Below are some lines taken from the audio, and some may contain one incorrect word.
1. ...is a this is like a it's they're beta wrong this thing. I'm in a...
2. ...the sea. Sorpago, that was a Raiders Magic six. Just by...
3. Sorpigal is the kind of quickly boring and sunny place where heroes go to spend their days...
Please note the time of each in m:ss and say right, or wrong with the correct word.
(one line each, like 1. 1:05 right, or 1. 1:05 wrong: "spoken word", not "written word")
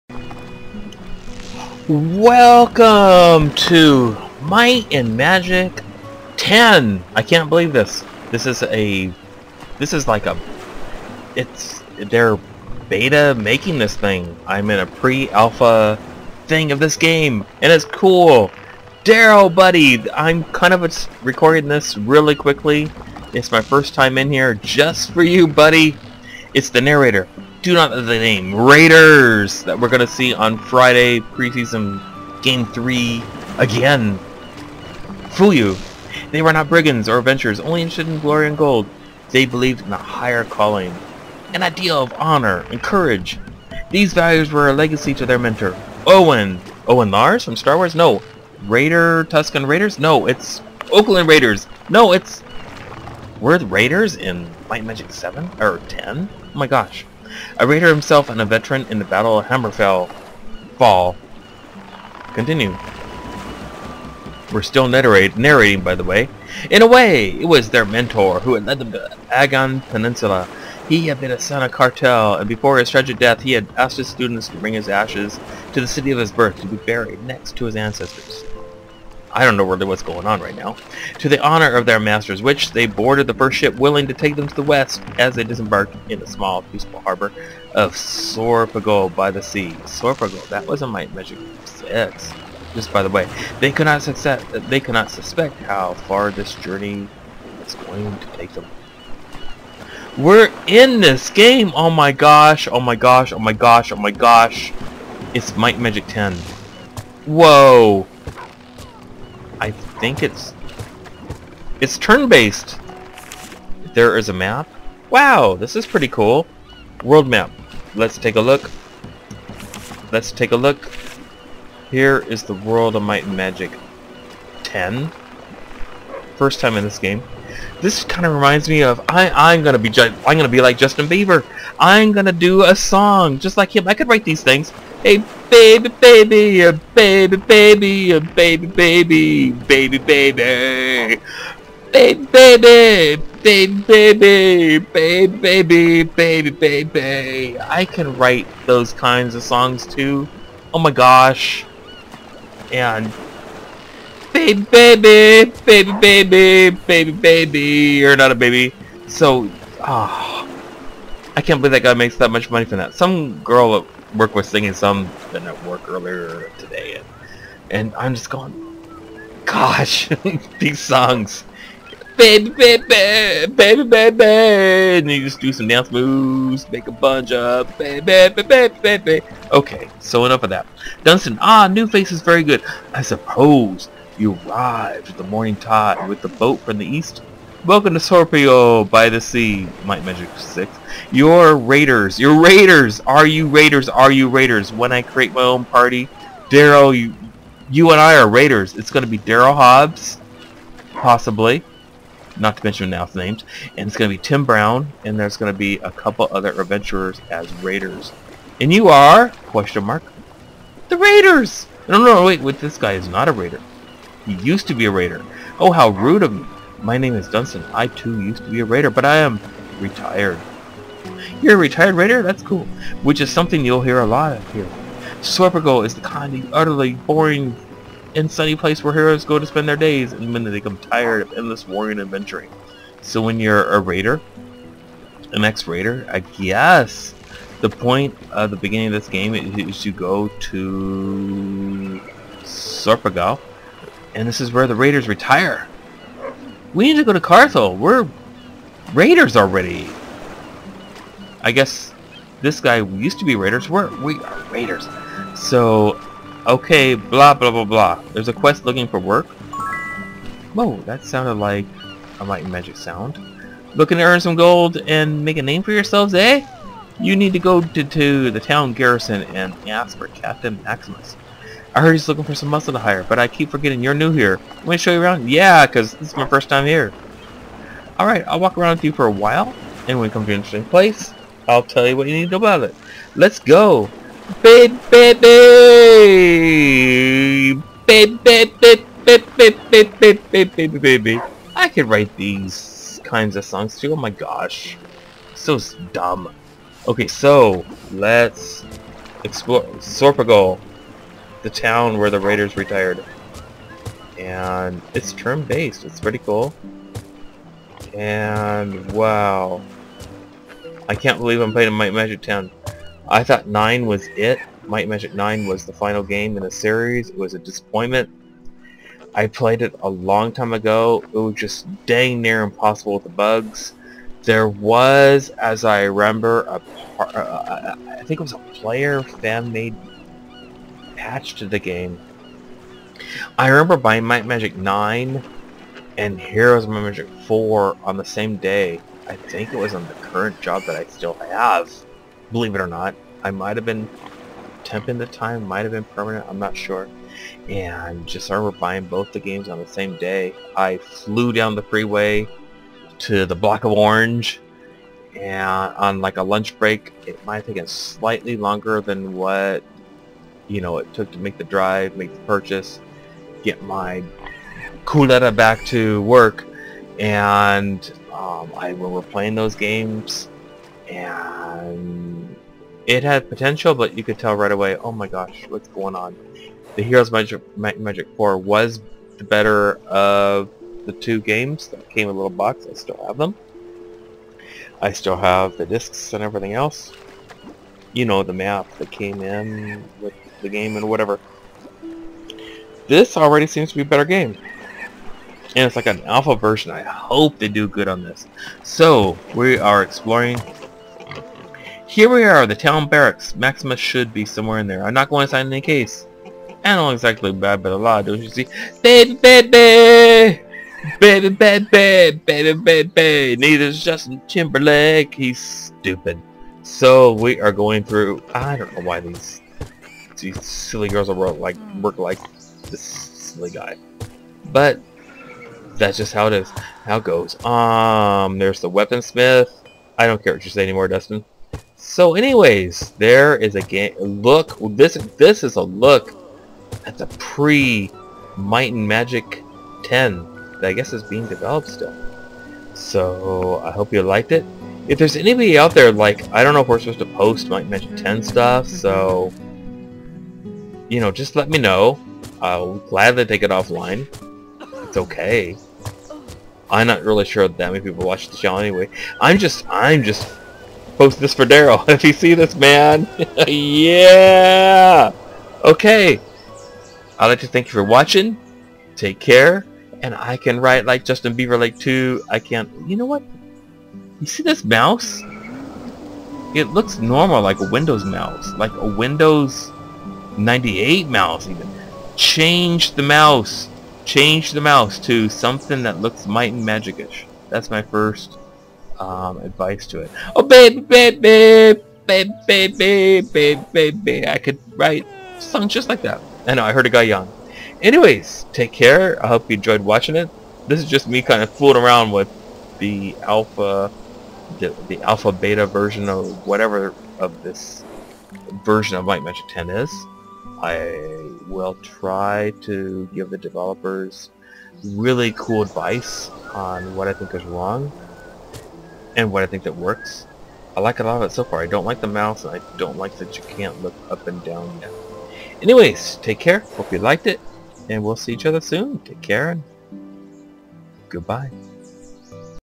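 1. 0:08 wrong: "making", not "wrong"
2. 1:29 wrong: "Might", not "Raiders"
3. 3:45 wrong: "utterly", not "quickly".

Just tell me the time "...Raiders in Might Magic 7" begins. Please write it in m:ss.
0:53.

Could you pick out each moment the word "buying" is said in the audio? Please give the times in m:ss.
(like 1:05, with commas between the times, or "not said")
5:33, 5:48.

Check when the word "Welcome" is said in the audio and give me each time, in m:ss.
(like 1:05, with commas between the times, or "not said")
0:01, 3:07.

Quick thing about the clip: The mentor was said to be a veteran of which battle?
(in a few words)
Battle of Hammerfell.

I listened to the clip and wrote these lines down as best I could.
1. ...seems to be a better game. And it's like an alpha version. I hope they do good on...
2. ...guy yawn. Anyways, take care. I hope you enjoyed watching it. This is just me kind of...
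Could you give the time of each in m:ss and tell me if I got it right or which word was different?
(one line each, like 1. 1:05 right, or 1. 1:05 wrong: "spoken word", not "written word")
1. 6:33 right
2. 8:16 right.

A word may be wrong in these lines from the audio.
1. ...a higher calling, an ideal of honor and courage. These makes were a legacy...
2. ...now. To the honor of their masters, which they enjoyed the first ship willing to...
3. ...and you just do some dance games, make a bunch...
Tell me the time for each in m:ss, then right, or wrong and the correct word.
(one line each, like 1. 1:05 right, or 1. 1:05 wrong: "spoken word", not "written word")
1. 0:39 wrong: "values", not "makes"
2. 1:20 wrong: "boarded", not "enjoyed"
3. 2:54 wrong: "moves", not "games".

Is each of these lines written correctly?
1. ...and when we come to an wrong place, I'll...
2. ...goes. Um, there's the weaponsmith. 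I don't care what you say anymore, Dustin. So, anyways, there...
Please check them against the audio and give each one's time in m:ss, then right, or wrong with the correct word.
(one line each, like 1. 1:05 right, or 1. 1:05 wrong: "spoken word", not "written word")
1. 4:39 wrong: "interesting", not "wrong"
2. 7:07 right.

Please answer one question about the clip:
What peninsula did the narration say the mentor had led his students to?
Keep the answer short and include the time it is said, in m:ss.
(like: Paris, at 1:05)
Agyn Peninsula, at 1:09.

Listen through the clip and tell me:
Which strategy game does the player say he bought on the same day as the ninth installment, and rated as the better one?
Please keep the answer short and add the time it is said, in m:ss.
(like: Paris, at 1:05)
Heroes of Might and Magic 4, at 5:36.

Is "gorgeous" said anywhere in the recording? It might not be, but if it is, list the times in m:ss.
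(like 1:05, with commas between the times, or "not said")
not said.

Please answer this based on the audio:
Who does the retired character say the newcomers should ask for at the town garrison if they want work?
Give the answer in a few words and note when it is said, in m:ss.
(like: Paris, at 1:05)
Captain Maximus, at 4:30.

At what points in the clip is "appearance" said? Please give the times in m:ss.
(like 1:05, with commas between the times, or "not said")
not said.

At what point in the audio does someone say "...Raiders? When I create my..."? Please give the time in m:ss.
3:14.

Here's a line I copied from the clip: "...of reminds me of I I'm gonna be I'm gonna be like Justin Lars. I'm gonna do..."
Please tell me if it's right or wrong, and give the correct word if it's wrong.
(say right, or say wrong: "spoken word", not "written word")
wrong: "Bieber", not "Lars".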